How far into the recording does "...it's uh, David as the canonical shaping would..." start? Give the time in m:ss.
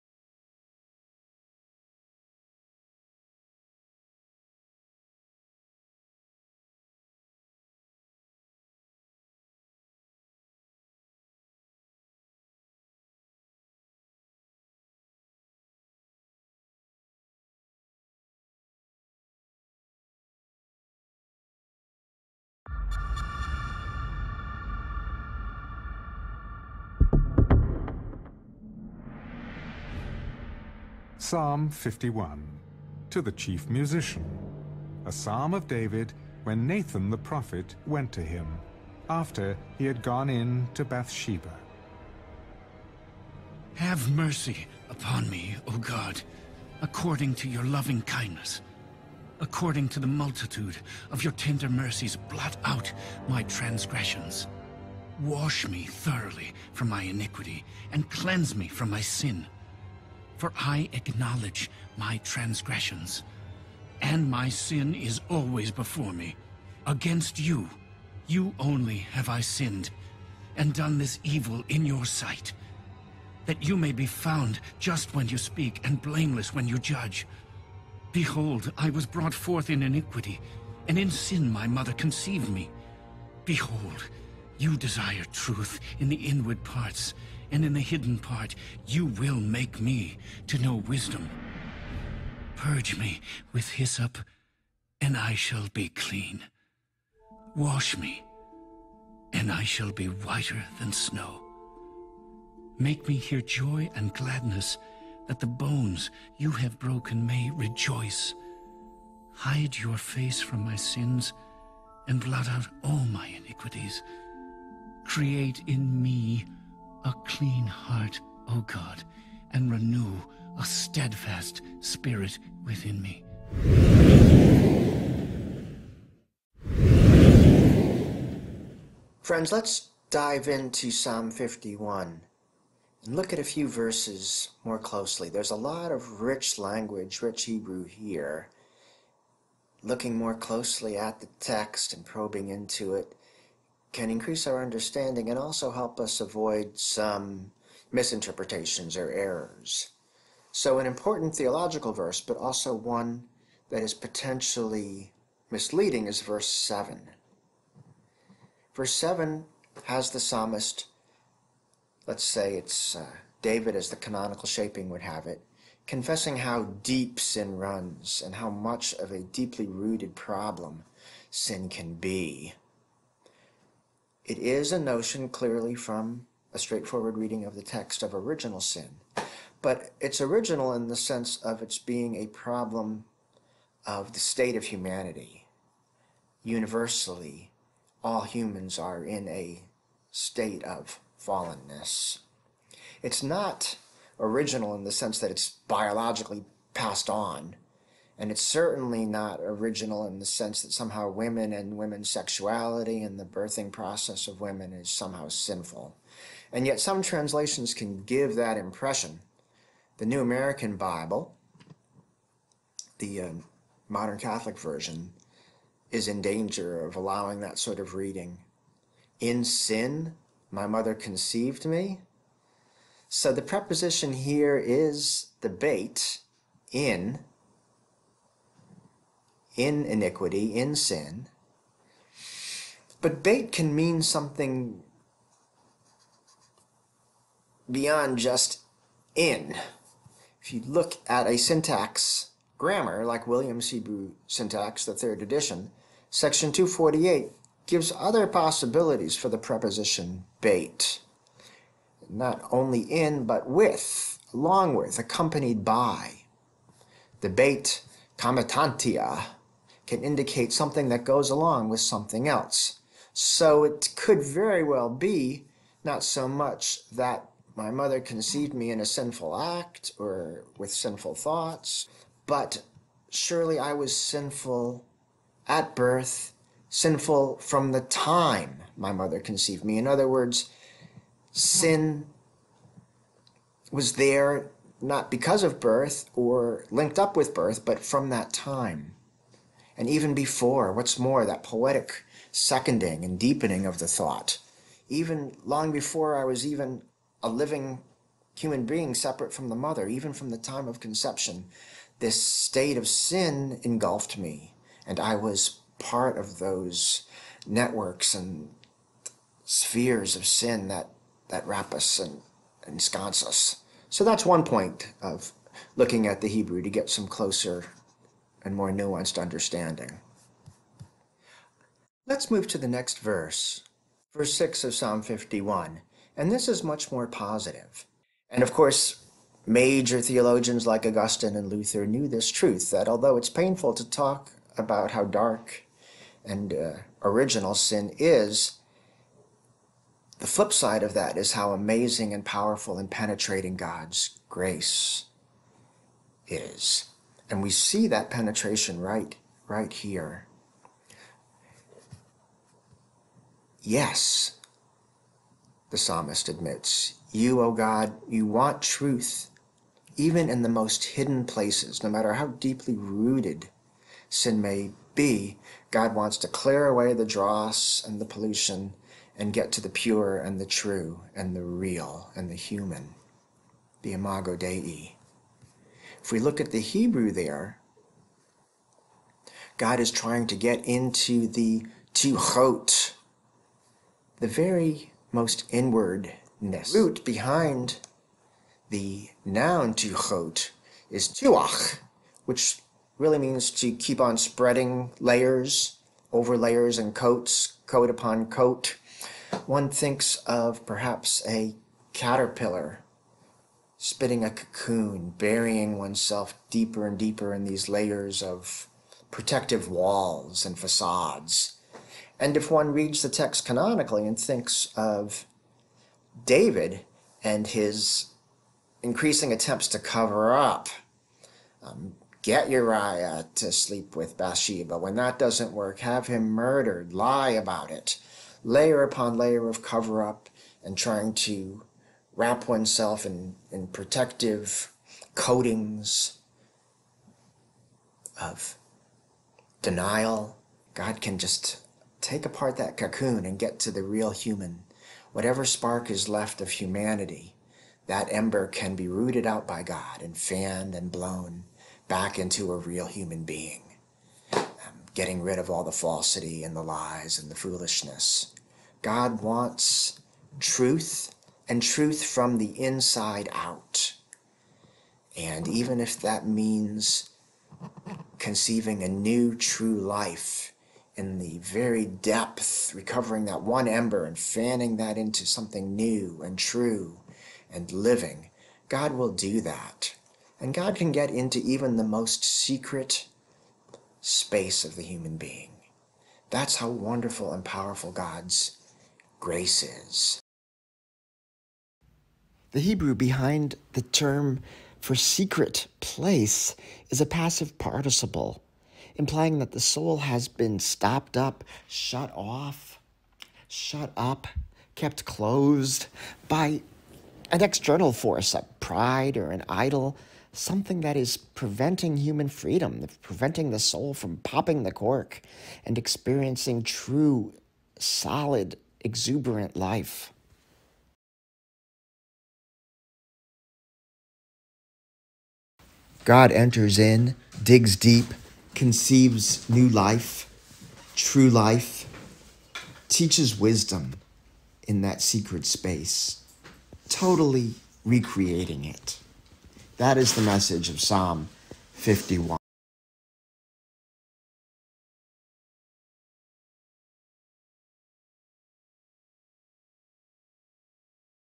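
2:42.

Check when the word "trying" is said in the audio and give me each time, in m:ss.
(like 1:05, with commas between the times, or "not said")
6:19, 7:10.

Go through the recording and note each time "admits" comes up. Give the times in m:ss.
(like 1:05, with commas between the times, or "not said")
5:56.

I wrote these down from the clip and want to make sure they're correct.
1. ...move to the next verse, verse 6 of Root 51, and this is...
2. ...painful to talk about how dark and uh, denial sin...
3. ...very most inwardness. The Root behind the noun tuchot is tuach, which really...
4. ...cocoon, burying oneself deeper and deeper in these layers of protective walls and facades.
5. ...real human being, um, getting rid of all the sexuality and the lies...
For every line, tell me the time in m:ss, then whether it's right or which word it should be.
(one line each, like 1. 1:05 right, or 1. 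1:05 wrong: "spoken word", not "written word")
1. 5:22 wrong: "Psalm", not "Root"
2. 5:33 wrong: "original", not "denial"
3. 6:24 right
4. 6:44 right
5. 7:32 wrong: "falsity", not "sexuality".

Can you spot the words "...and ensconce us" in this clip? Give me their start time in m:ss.
5:11.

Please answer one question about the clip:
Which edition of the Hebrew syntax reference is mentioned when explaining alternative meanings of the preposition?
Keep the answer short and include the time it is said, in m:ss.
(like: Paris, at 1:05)
Third edition, at 4:04.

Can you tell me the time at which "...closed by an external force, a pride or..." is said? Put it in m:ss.
8:25.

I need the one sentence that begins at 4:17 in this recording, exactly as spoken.
The bait comitantia can indicate something that goes along with something else.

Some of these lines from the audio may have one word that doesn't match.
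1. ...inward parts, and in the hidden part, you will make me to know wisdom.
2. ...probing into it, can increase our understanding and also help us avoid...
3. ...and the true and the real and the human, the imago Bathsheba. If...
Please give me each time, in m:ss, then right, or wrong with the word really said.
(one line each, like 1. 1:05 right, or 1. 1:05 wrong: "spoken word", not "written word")
1. 1:26 right
2. 2:22 right
3. 6:10 wrong: "Dei", not "Bathsheba".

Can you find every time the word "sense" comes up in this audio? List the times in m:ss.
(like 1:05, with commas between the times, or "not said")
3:00, 3:14, 3:20.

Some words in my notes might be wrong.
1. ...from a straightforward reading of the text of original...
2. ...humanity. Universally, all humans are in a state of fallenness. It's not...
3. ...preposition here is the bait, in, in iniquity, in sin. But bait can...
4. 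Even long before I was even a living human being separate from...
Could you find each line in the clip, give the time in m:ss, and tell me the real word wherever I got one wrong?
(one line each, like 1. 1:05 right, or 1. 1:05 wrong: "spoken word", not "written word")
1. 2:55 right
2. 3:04 right
3. 3:43 right
4. 4:54 right.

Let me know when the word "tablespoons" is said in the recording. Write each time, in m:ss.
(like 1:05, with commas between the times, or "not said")
not said.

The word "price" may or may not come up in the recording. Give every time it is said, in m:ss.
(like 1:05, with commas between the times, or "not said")
not said.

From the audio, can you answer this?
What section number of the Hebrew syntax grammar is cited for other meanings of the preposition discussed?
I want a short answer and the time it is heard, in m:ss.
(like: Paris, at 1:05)
248, at 4:06.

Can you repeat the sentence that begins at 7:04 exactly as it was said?
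When that doesn't work, have him murdered, lie about it.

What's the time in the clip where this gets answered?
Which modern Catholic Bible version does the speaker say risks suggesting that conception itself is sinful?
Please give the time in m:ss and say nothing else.
3:29.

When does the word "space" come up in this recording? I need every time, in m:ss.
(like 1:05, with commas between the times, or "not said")
8:03, 8:55.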